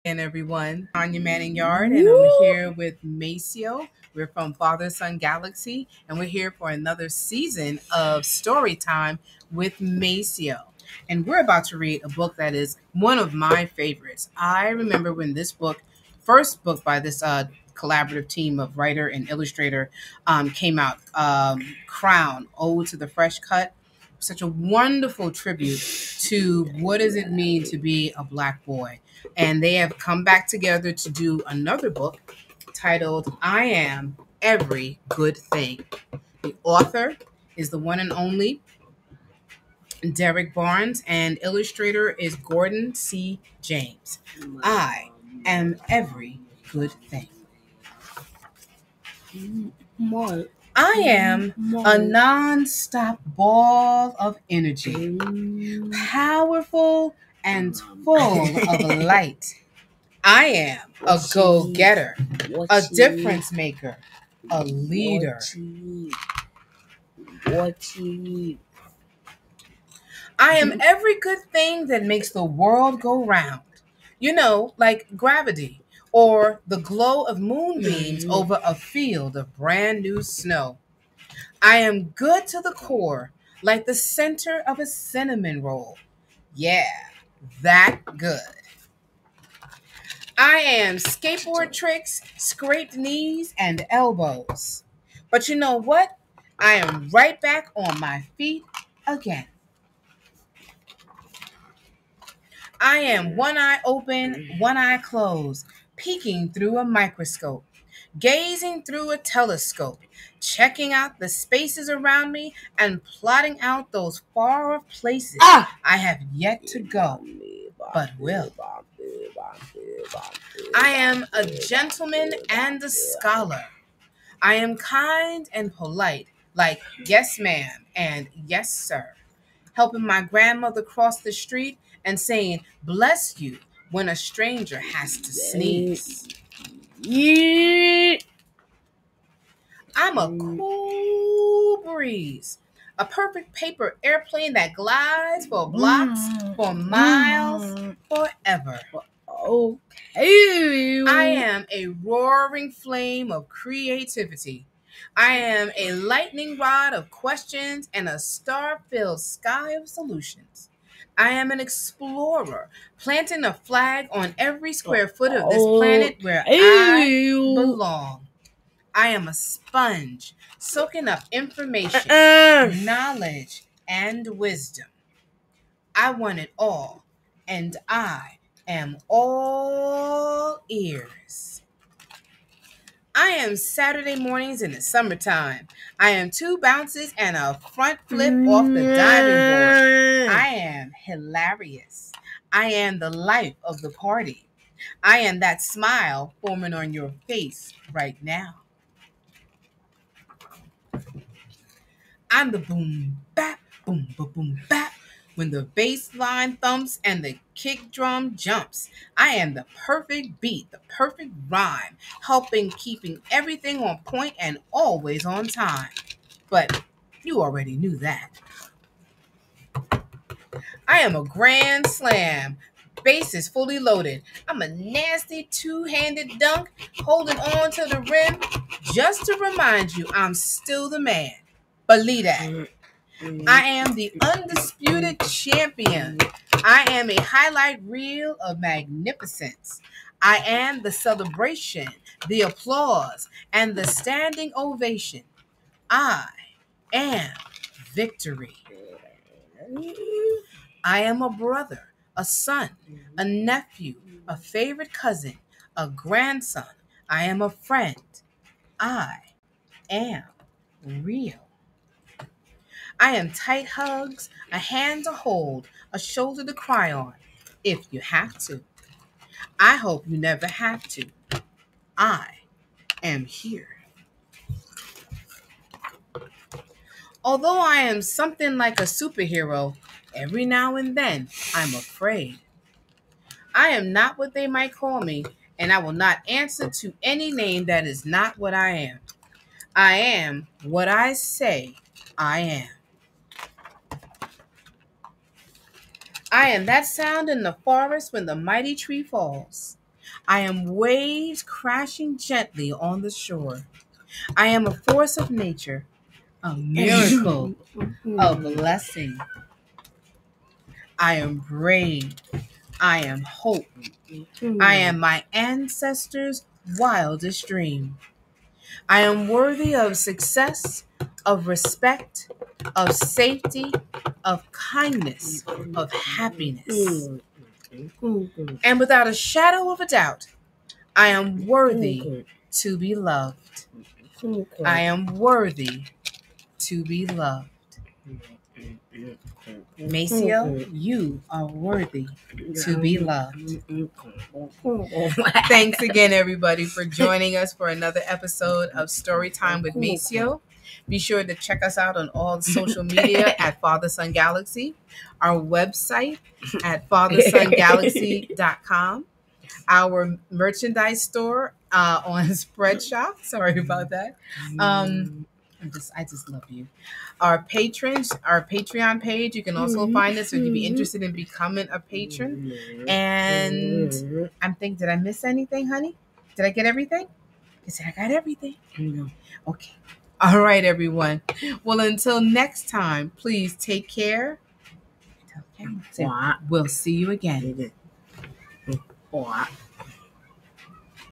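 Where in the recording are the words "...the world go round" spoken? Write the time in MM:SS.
01:12.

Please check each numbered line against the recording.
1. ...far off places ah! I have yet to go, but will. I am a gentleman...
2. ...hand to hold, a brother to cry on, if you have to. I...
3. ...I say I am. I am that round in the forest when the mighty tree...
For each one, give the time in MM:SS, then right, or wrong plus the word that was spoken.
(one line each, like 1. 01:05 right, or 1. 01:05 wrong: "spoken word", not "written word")
1. 01:54 right
2. 04:24 wrong: "shoulder", not "brother"
3. 04:50 wrong: "sound", not "round".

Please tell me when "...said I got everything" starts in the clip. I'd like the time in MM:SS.
06:17.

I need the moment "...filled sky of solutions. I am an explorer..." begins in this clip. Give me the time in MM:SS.
02:38.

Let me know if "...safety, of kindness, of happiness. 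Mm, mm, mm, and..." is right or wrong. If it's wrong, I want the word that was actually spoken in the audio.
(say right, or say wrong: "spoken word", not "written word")
right.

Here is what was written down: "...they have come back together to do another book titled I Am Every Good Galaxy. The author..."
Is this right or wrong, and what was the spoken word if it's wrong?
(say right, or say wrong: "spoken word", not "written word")
wrong: "Thing", not "Galaxy".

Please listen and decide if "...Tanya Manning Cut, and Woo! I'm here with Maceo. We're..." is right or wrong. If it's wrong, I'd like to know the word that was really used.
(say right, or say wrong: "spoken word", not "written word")
wrong: "Yarde", not "Cut".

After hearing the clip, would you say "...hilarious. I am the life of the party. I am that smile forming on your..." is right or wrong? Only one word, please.
right.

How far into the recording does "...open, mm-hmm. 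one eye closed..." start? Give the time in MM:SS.
01:43.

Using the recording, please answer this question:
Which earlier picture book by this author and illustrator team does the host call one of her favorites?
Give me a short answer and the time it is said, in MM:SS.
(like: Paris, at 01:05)
Crown, Ode to the Fresh Cut, at 00:21.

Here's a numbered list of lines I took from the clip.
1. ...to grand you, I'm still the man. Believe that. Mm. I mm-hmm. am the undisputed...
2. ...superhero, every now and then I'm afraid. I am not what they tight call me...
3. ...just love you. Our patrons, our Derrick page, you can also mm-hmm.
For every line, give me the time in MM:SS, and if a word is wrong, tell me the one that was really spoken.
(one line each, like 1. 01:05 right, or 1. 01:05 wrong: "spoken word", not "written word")
1. 03:49 wrong: "remind", not "grand"
2. 04:38 wrong: "might", not "tight"
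3. 06:06 wrong: "Patreon", not "Derrick".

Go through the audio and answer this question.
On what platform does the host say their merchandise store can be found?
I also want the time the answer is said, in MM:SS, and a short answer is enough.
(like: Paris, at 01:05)
Spreadshop, at 06:02.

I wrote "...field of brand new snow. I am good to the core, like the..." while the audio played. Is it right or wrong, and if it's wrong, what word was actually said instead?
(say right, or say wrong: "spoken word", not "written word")
right.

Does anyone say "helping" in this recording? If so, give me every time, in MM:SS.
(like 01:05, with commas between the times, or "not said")
02:09, 03:32.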